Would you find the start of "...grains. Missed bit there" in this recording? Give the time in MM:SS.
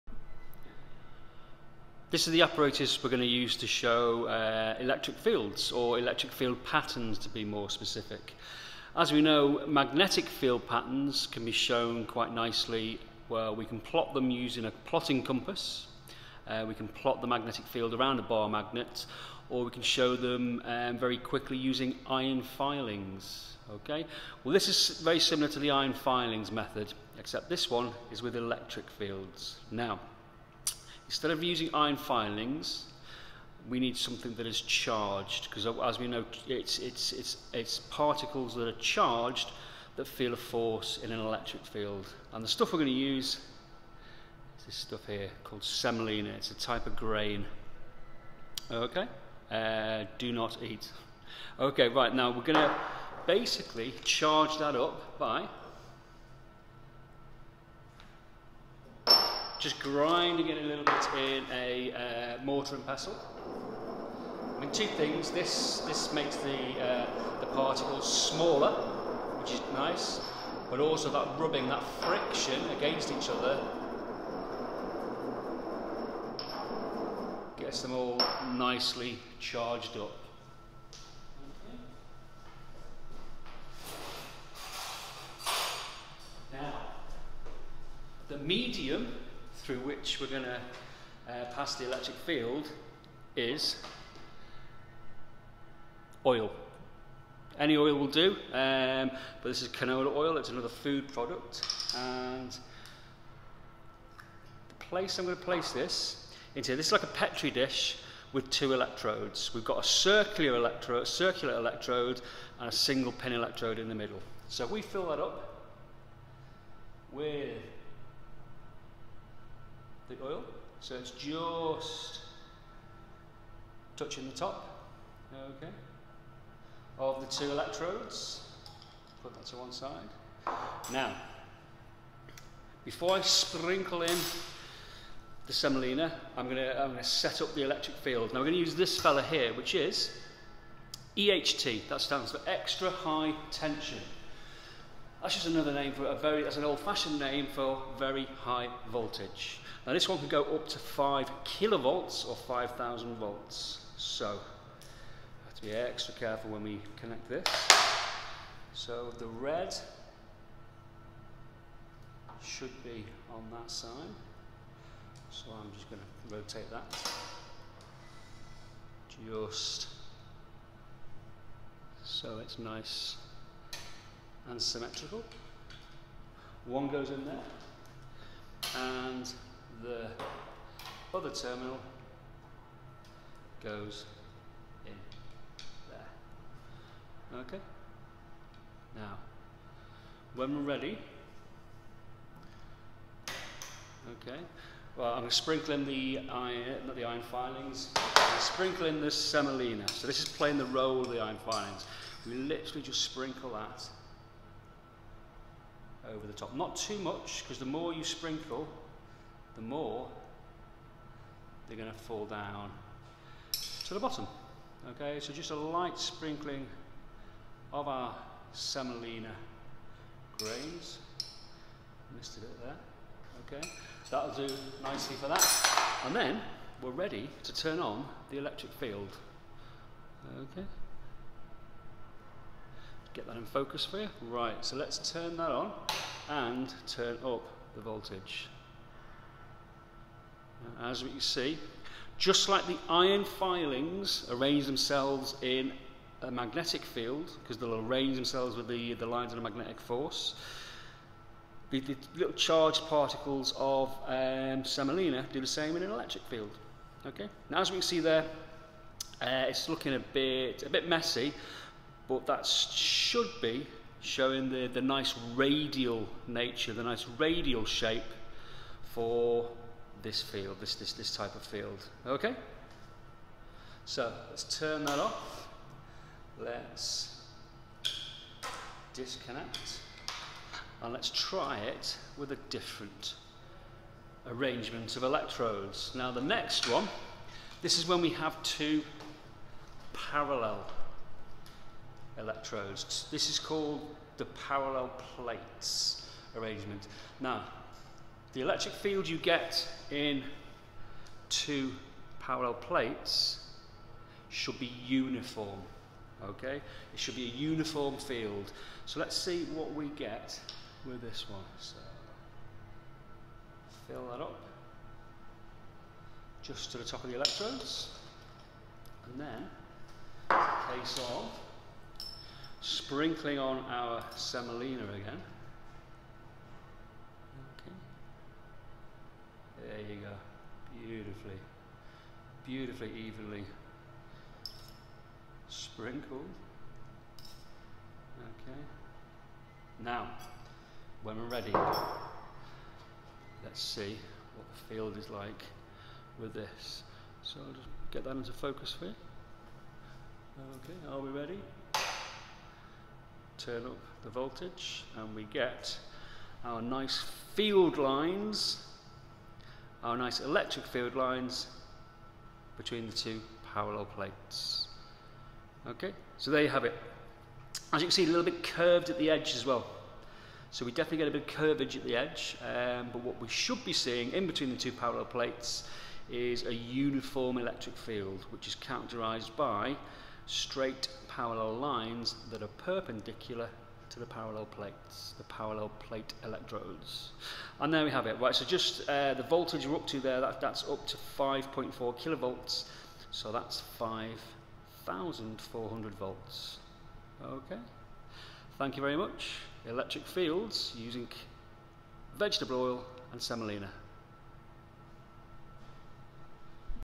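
03:40.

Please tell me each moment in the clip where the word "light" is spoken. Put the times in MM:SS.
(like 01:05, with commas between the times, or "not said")
03:35.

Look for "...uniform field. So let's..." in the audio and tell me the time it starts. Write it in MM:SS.
05:07.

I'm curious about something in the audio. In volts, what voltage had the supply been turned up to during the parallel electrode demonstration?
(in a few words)
5,400 volts.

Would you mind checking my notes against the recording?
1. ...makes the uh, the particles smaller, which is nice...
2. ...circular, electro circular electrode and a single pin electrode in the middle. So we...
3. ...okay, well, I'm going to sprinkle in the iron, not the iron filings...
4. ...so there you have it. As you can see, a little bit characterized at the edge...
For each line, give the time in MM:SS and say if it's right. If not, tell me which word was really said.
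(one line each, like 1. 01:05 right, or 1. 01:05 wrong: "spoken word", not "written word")
1. 01:06 right
2. 01:49 right
3. 03:14 right
4. 06:06 wrong: "curved", not "characterized".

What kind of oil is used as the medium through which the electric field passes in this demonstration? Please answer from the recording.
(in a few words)
canola oil.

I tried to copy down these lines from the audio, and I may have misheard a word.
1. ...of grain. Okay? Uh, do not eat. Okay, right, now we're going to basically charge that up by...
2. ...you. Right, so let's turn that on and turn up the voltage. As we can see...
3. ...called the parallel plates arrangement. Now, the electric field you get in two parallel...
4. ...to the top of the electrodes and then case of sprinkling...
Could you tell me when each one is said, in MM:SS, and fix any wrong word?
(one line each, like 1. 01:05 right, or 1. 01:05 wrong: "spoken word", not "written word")
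1. 00:46 right
2. 03:53 right
3. 04:53 right
4. 05:16 right.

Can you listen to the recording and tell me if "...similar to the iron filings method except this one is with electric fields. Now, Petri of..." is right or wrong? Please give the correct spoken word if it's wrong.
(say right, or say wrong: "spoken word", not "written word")
wrong: "Instead", not "Petri".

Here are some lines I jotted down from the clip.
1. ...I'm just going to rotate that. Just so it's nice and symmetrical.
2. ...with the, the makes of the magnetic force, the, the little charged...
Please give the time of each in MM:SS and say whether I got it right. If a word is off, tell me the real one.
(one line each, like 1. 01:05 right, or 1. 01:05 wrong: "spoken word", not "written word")
1. 02:45 right
2. 04:08 wrong: "lines", not "makes".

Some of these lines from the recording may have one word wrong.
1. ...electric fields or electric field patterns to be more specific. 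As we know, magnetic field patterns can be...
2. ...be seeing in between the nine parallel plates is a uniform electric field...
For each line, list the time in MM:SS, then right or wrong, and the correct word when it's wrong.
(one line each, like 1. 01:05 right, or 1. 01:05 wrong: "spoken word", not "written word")
1. 00:04 right
2. 06:13 wrong: "two", not "nine".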